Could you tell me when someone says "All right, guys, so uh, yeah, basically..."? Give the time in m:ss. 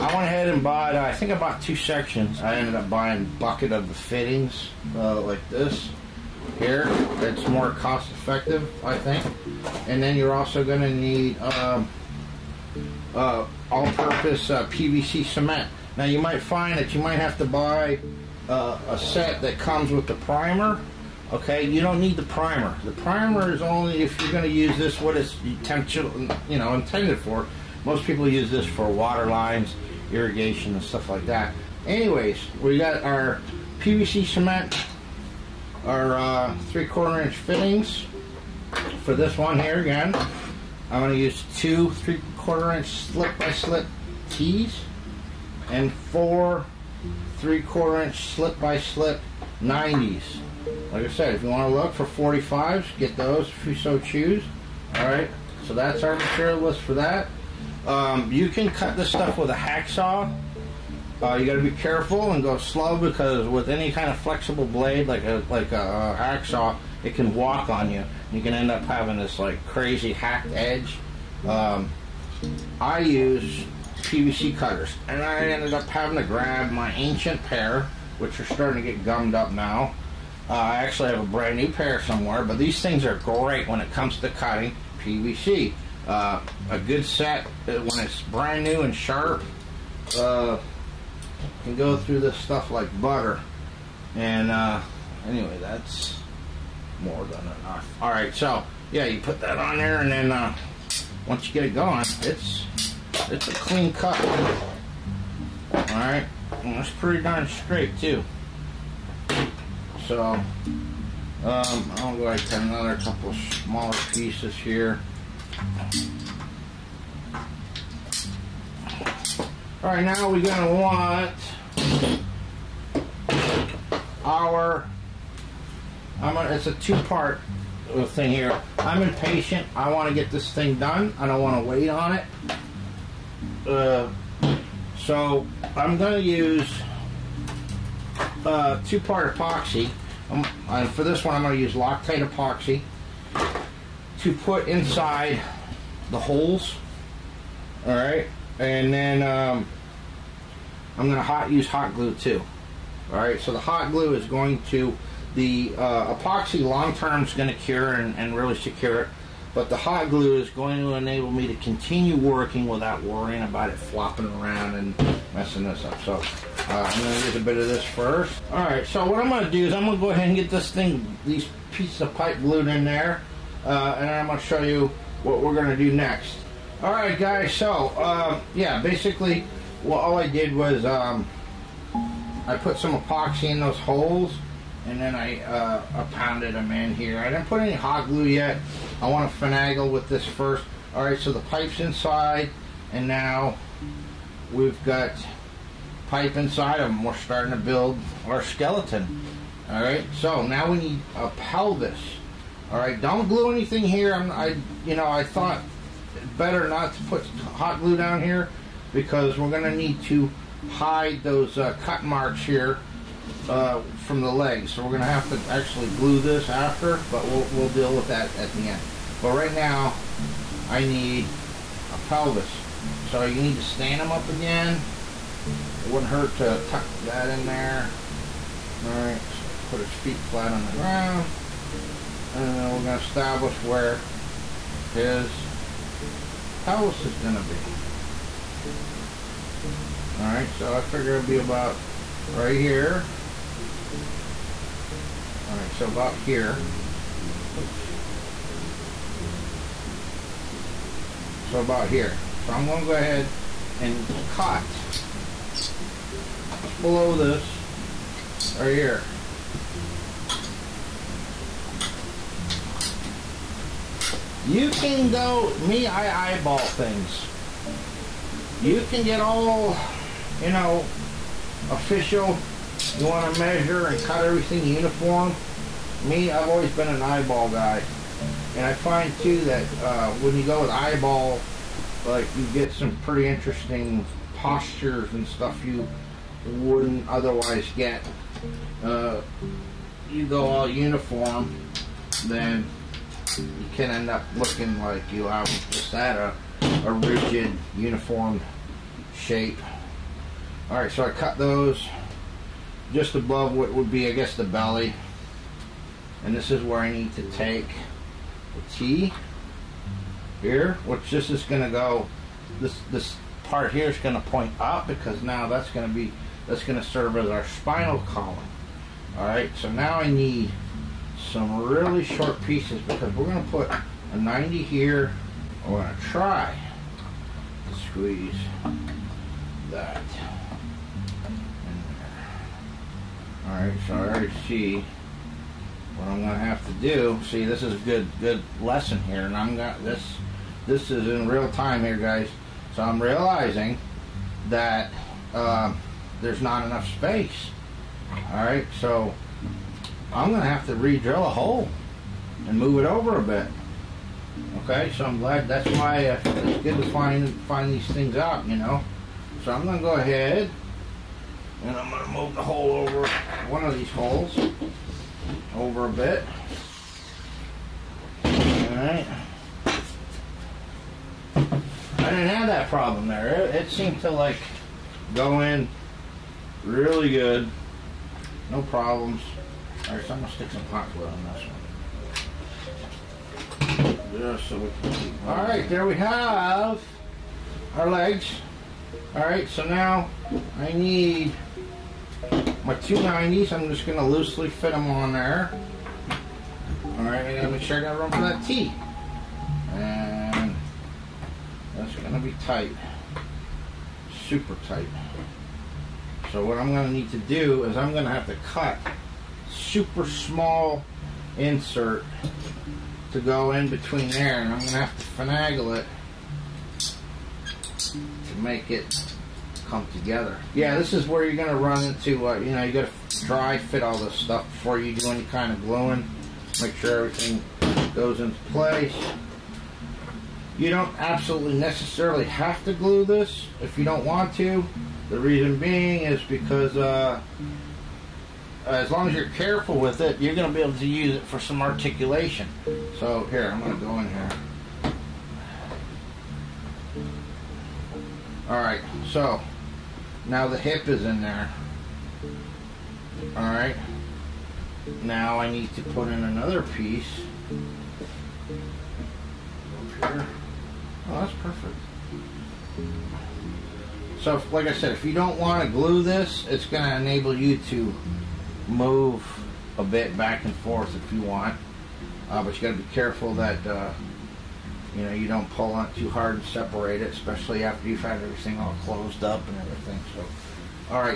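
2:56.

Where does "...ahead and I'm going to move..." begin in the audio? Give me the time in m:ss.
5:59.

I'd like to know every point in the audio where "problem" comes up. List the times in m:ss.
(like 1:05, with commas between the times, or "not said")
6:12, 6:18.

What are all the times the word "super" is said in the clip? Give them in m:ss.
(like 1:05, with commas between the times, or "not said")
6:44, 6:49.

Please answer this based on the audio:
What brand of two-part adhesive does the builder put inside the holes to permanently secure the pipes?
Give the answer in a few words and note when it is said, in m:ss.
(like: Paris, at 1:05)
Loctite, at 2:21.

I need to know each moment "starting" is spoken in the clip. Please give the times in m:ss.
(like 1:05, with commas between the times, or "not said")
1:18, 3:17.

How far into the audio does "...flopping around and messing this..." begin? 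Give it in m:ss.
2:43.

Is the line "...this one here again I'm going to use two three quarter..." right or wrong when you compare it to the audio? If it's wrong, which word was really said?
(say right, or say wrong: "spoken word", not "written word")
right.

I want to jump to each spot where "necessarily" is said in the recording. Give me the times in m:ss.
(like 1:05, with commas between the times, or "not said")
7:11.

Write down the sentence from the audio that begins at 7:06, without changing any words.
Make sure everything goes into place.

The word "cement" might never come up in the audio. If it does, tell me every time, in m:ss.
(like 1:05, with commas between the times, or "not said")
0:15, 0:34.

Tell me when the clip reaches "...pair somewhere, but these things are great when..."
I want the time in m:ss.
1:21.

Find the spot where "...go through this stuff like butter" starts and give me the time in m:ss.
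1:31.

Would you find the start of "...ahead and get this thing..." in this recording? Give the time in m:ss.
2:50.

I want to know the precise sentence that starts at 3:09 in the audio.
I want to finagle with this first.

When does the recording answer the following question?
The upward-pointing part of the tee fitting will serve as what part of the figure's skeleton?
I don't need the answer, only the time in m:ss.
5:17.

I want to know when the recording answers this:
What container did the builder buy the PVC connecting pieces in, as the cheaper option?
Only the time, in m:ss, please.
0:03.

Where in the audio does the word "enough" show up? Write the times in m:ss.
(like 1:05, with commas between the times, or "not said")
1:37, 5:46.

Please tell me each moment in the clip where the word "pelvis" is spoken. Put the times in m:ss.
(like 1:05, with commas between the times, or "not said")
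3:21, 3:42, 3:56.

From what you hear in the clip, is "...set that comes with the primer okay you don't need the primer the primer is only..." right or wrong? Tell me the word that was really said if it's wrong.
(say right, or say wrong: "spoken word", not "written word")
right.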